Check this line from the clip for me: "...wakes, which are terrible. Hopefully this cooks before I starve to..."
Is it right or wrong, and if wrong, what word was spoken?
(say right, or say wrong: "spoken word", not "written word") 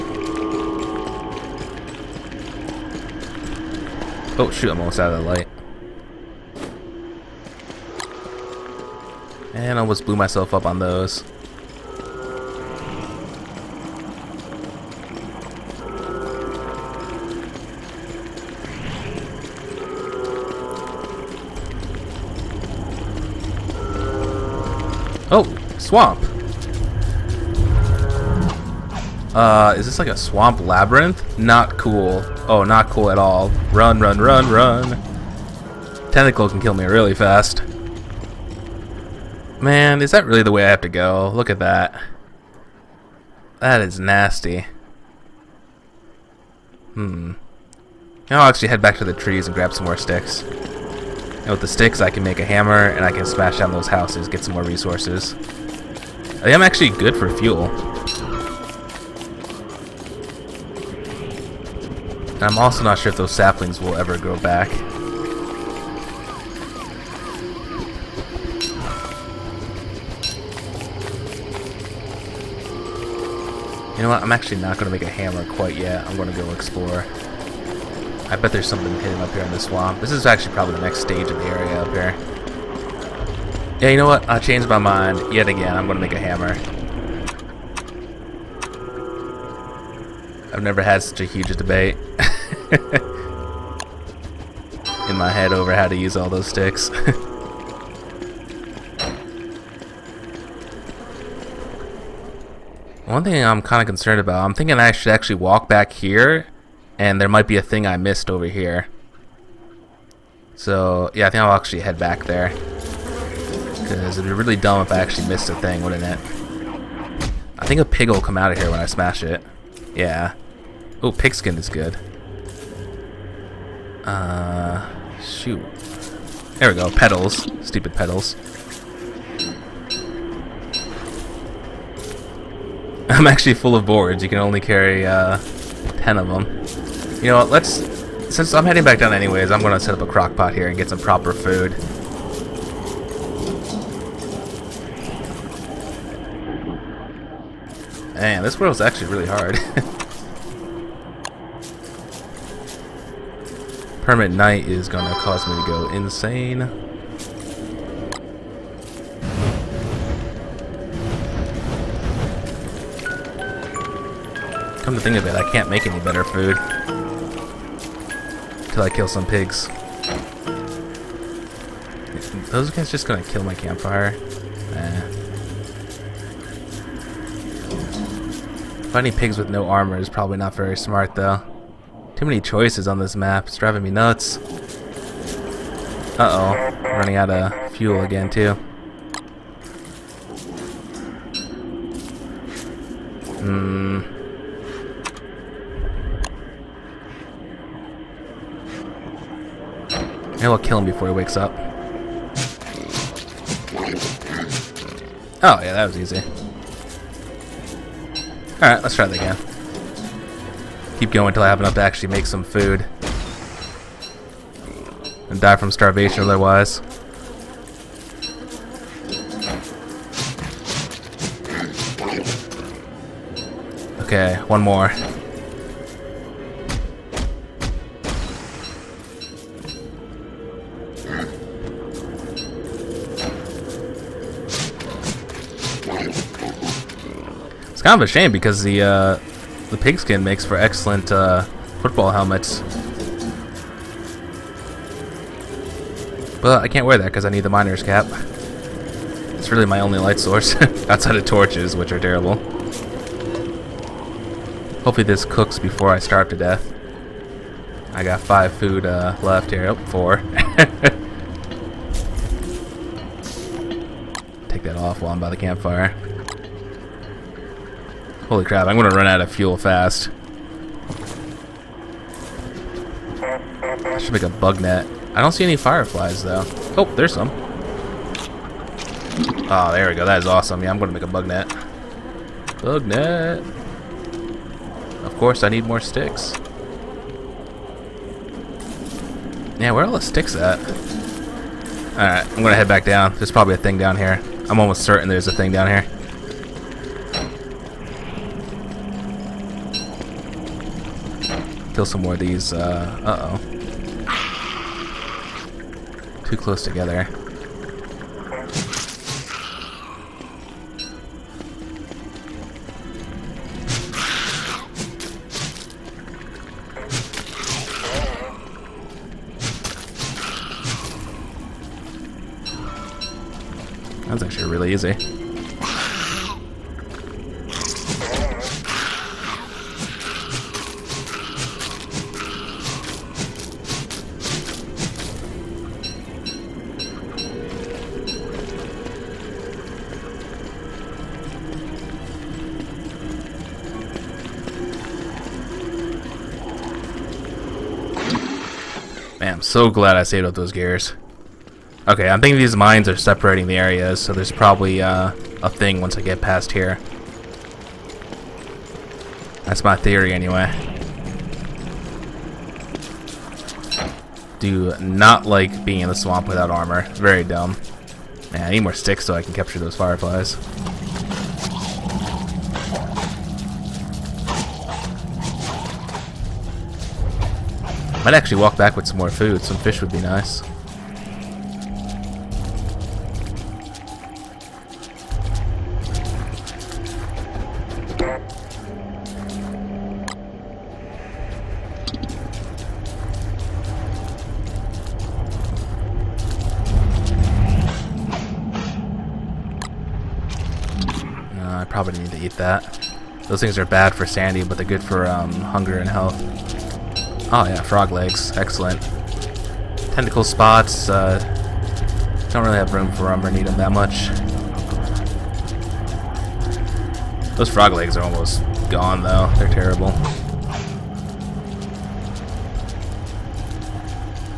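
wrong: "torches", not "wakes".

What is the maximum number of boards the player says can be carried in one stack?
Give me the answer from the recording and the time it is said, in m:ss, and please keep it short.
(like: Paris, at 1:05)
10, at 2:15.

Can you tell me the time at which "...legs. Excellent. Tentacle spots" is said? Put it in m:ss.
6:47.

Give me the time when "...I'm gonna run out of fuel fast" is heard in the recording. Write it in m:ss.
4:28.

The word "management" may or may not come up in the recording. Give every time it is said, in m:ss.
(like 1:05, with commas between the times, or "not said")
not said.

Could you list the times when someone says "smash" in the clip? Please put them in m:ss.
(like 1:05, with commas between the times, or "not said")
0:53, 1:58.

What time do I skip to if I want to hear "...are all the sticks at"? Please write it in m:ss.
4:49.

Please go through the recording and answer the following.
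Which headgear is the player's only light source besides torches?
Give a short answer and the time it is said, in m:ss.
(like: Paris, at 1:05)
miner's cap, at 4:07.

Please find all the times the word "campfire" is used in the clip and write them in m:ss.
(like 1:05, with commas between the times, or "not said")
2:53, 4:25.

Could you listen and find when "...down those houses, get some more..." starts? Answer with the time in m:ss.
0:53.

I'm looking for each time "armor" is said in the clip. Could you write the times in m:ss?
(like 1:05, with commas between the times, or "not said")
2:59, 6:06.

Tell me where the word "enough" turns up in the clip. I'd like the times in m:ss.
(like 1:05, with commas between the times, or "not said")
3:31.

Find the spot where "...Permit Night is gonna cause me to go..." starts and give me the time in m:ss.
2:34.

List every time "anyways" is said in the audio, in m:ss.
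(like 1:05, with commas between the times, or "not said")
2:19, 6:00.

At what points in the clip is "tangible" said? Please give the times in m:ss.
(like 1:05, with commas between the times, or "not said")
not said.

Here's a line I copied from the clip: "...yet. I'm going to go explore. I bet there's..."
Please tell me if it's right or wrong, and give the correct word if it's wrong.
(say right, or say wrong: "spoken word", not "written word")
right.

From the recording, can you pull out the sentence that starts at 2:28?
Man, this world's actually really hard.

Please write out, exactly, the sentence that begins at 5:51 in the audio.
Okay, I'm thinking these mines are separating the areas, so there's probably uh, a thing once I get past here.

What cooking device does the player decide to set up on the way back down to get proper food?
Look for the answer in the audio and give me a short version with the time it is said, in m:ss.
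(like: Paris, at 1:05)
crock pot, at 2:20.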